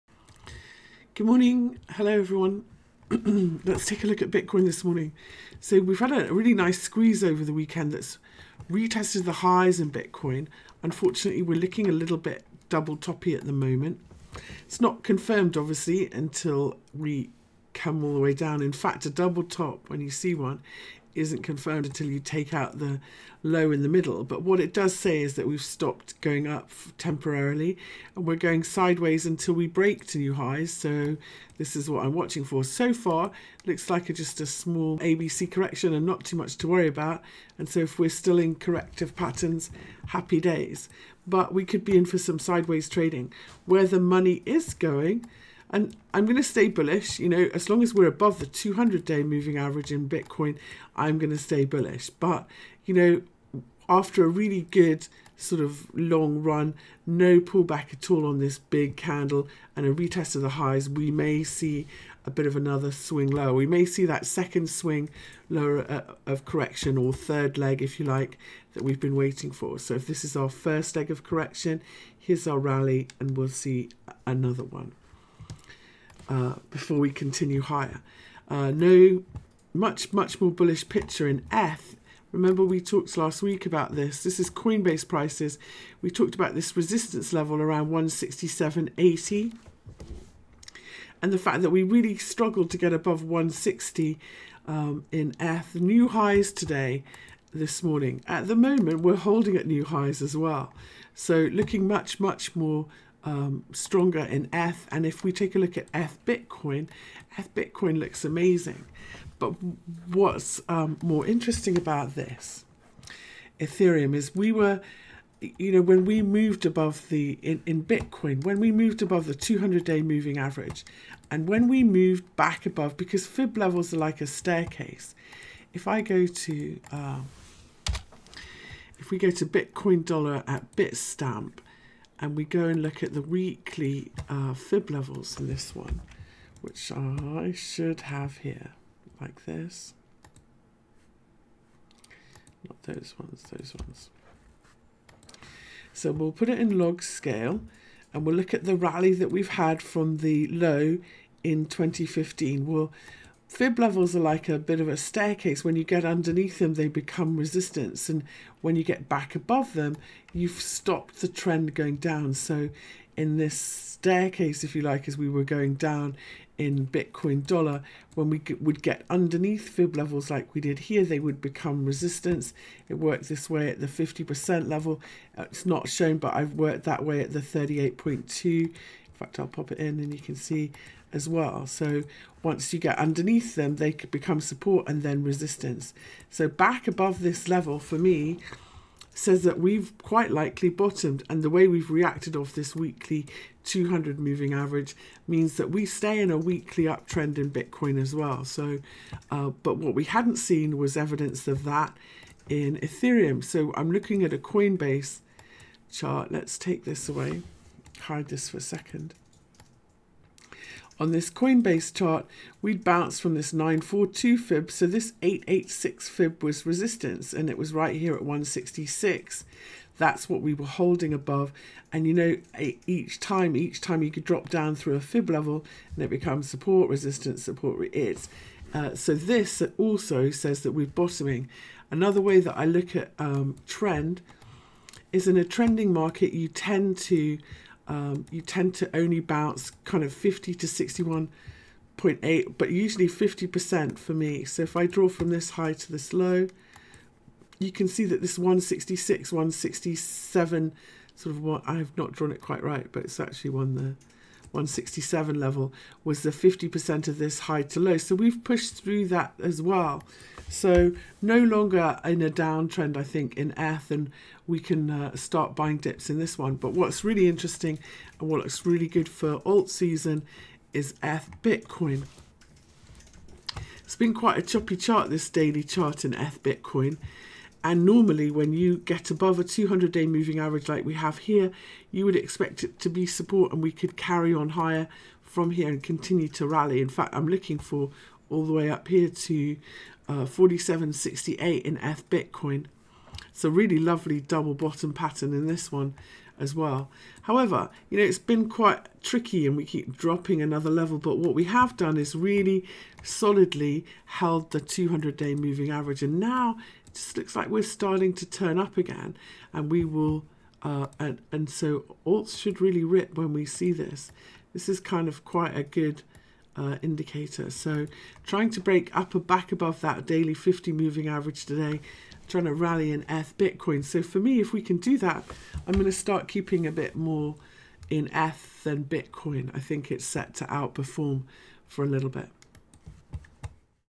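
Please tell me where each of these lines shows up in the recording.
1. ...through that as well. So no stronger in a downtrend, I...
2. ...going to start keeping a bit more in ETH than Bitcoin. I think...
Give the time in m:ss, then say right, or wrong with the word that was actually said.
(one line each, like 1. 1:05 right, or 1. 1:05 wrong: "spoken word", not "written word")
1. 4:18 wrong: "longer", not "stronger"
2. 5:25 right.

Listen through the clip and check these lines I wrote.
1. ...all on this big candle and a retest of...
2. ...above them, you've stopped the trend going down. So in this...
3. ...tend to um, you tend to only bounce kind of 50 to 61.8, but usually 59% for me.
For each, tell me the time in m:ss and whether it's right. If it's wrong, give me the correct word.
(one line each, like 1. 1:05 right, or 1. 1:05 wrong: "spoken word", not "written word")
1. 0:58 right
2. 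2:39 right
3. 3:56 wrong: "50", not "59".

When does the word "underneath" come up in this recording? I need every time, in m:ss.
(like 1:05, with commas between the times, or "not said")
2:36, 2:49, 3:02.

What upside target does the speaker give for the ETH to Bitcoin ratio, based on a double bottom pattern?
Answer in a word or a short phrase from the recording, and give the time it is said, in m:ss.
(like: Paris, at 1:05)
47.68, at 4:50.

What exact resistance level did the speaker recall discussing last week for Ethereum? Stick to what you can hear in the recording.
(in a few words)
167.80.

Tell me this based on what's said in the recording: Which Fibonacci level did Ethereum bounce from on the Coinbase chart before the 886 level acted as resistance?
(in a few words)
942.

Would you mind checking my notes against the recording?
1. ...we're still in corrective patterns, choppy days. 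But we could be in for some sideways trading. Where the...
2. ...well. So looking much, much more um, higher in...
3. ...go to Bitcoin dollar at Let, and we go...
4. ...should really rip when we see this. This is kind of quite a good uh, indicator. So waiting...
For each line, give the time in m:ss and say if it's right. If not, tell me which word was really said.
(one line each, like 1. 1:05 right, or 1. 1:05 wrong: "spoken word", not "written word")
1. 0:37 wrong: "happy", not "choppy"
2. 1:40 wrong: "stronger", not "higher"
3. 2:09 wrong: "Bitstamp", not "Let"
4. 5:12 wrong: "trying", not "waiting".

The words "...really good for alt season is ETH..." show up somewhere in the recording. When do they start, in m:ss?
4:28.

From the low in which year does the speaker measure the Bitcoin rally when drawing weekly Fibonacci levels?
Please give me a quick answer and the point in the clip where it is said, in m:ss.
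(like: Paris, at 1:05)
2015, at 2:31.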